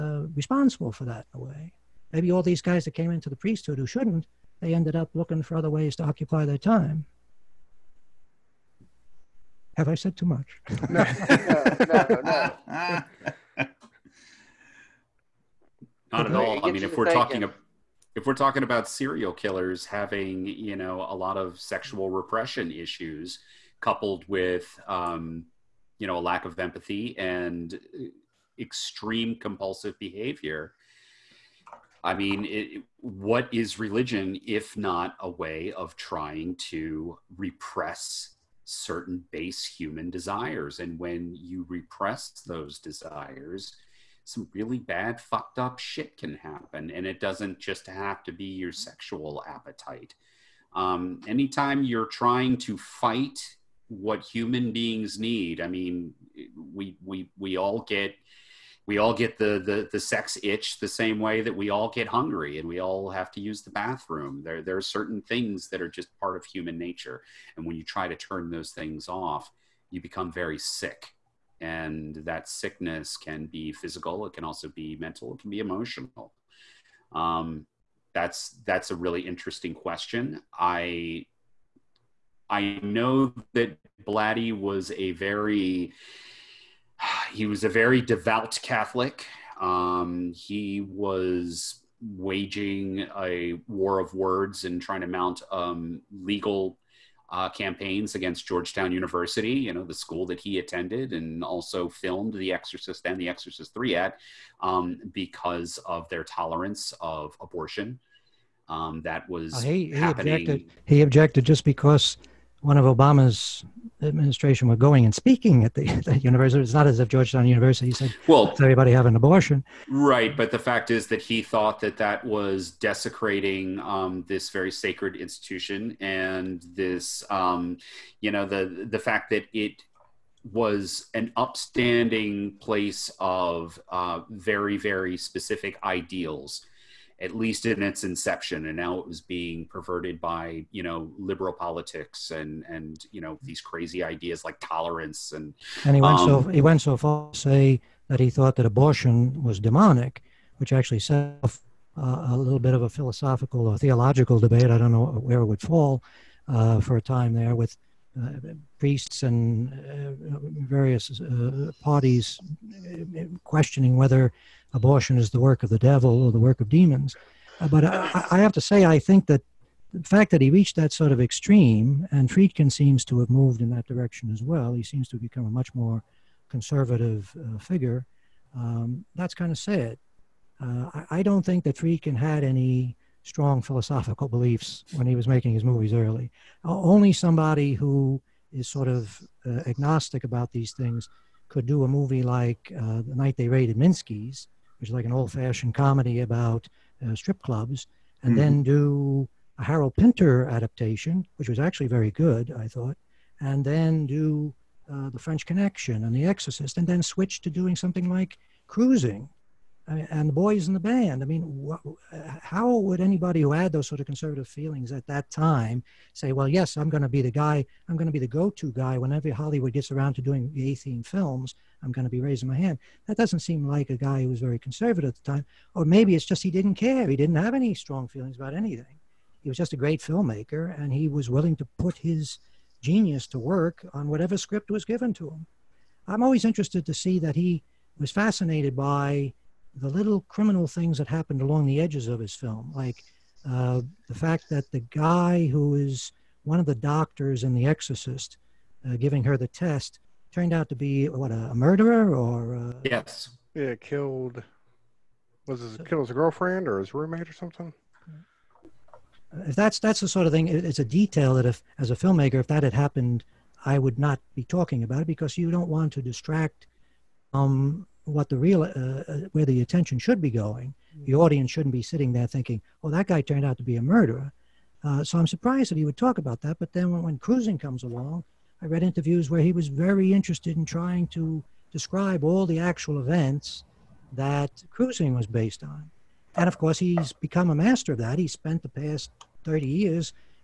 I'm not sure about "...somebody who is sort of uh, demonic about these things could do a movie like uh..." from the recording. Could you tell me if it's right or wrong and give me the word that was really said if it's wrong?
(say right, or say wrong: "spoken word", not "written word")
wrong: "agnostic", not "demonic".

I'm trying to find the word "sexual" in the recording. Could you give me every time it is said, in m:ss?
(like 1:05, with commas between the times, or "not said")
0:21, 0:48.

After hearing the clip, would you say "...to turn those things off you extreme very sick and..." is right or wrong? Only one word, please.
wrong.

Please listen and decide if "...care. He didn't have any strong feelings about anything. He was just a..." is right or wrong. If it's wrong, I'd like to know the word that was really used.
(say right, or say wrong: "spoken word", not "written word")
right.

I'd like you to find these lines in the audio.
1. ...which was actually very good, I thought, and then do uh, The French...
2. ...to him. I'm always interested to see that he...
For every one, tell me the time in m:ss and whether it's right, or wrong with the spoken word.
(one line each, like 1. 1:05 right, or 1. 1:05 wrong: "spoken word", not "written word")
1. 3:21 right
2. 3:55 right.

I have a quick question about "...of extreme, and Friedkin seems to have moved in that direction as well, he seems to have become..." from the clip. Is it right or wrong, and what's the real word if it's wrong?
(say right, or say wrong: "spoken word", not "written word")
right.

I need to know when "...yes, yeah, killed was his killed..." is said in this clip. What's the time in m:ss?
4:12.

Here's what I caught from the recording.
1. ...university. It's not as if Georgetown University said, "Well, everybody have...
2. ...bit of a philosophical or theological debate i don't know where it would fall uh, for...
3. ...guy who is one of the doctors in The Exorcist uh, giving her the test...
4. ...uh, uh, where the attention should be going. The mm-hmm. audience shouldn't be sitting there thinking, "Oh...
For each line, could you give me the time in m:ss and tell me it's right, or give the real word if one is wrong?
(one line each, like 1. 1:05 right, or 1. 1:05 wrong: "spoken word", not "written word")
1. 1:56 right
2. 2:32 right
3. 4:04 right
4. 4:28 right.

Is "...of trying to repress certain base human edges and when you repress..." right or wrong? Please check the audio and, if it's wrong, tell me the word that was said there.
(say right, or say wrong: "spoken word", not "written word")
wrong: "desires", not "edges".